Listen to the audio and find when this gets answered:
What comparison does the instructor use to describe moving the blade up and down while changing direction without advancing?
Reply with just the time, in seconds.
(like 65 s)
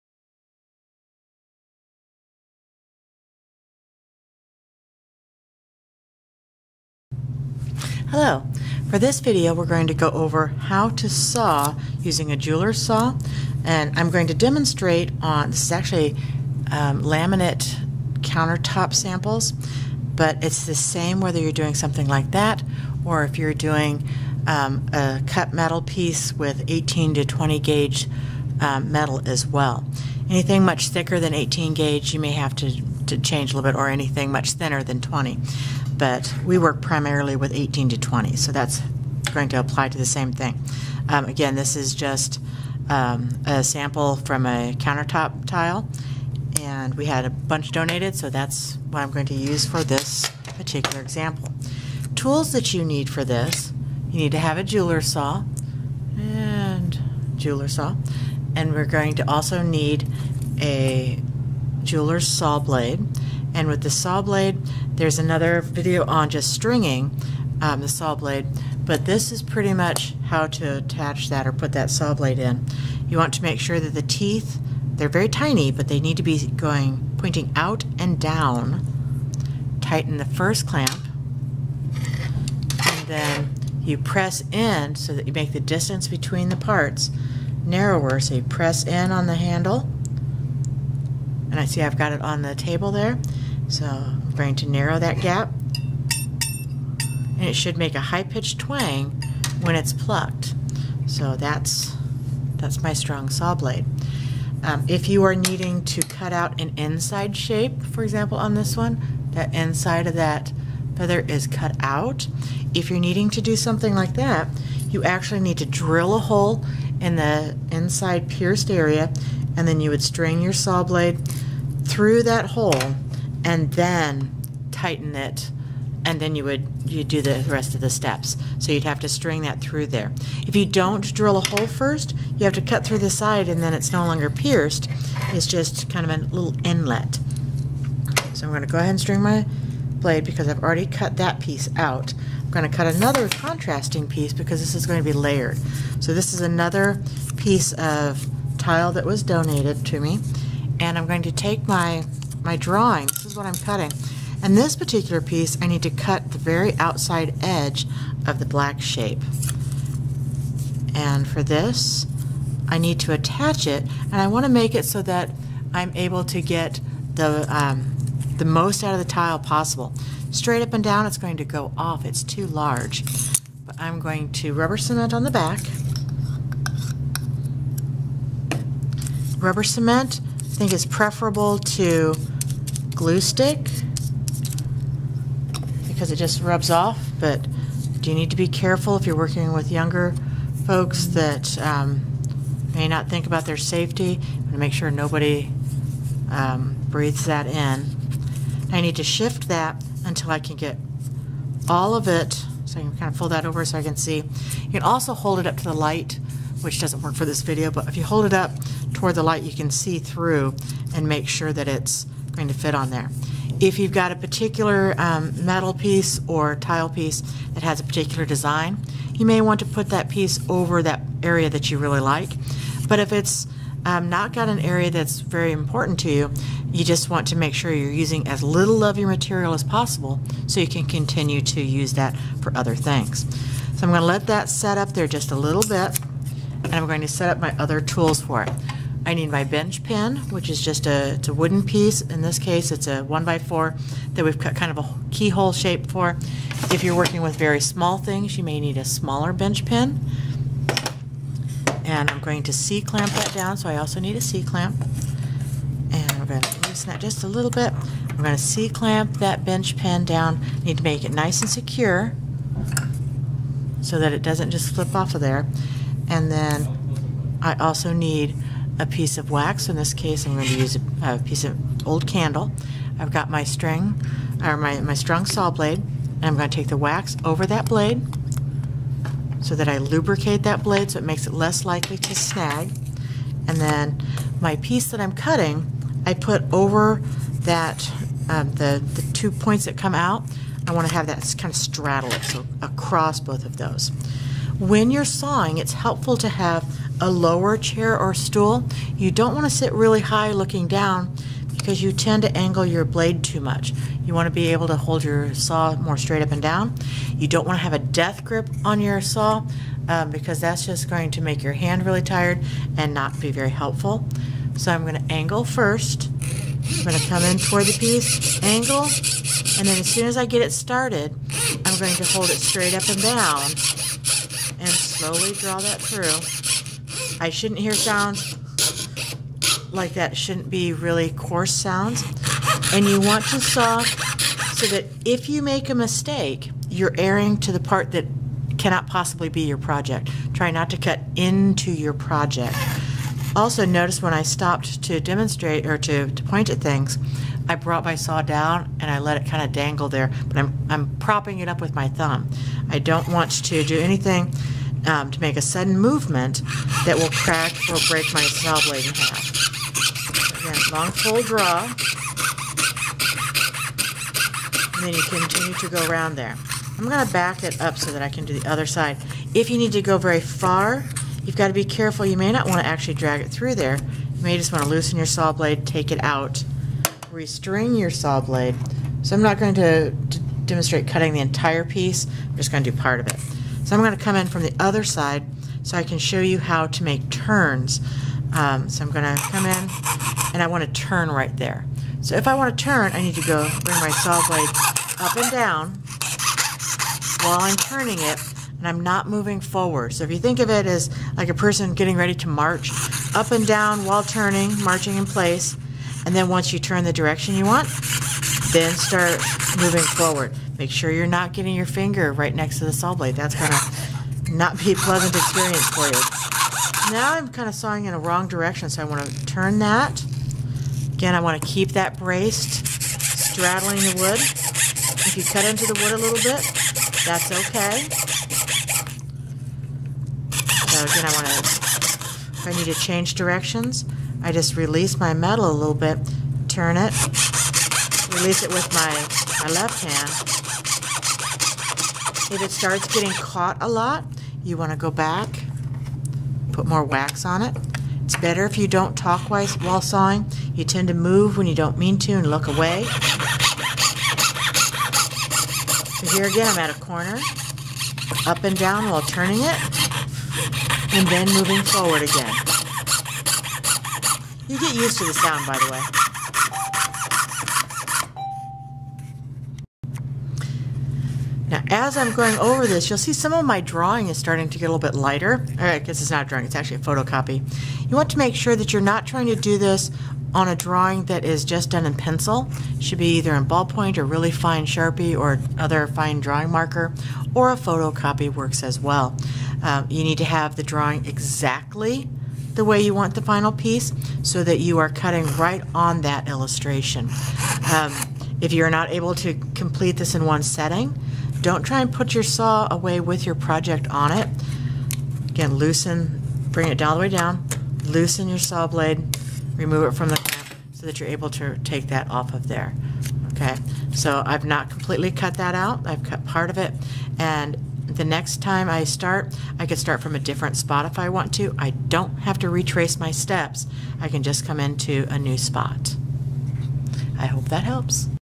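404 s.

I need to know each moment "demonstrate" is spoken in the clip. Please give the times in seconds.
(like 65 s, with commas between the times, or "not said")
14 s, 344 s, 380 s.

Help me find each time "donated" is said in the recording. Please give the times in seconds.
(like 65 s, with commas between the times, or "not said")
47 s, 149 s.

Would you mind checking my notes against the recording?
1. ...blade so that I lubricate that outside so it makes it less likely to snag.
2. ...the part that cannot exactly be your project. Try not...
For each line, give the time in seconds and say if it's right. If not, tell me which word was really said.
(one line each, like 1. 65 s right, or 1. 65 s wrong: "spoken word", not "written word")
1. 277 s wrong: "blade", not "outside"
2. 337 s wrong: "possibly", not "exactly".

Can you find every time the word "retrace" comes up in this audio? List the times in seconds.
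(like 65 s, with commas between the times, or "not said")
522 s.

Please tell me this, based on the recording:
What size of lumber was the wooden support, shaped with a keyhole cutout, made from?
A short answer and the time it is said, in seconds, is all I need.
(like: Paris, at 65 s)
One by four, at 243 s.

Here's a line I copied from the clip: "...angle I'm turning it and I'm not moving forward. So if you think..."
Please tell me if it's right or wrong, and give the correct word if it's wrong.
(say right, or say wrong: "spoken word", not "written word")
wrong: "while", not "angle".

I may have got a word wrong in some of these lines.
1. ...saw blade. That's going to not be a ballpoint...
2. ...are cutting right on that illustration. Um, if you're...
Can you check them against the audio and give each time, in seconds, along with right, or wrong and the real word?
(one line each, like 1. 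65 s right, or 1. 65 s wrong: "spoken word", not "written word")
1. 412 s wrong: "pleasant", not "ballpoint"
2. 494 s right.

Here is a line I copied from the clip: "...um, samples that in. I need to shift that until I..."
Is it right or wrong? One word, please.
wrong.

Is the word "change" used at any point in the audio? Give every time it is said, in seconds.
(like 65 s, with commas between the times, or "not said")
33 s, 432 s.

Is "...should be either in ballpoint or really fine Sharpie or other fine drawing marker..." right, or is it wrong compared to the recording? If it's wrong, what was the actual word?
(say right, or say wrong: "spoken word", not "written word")
right.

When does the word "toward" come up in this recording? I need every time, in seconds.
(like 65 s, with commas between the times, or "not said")
208 s, 317 s.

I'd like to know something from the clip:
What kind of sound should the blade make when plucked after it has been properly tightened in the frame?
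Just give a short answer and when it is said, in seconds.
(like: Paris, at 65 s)
High-pitched twang, at 97 s.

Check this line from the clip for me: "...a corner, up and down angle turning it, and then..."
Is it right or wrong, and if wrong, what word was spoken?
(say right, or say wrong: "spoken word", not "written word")
wrong: "while", not "angle".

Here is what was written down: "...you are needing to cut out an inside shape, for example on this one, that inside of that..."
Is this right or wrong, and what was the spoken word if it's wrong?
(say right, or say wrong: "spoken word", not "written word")
right.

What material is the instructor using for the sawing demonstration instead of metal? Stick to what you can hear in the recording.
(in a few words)
Laminate countertop samples.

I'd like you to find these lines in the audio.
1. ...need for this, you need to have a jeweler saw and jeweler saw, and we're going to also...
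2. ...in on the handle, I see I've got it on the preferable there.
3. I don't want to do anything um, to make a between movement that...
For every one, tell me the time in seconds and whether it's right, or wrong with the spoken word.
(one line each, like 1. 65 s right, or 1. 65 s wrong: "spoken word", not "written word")
1. 52 s right
2. 88 s wrong: "table", not "preferable"
3. 352 s wrong: "sudden", not "between".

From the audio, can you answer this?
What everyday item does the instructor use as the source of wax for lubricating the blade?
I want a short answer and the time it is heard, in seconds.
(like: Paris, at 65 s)
Old candle, at 271 s.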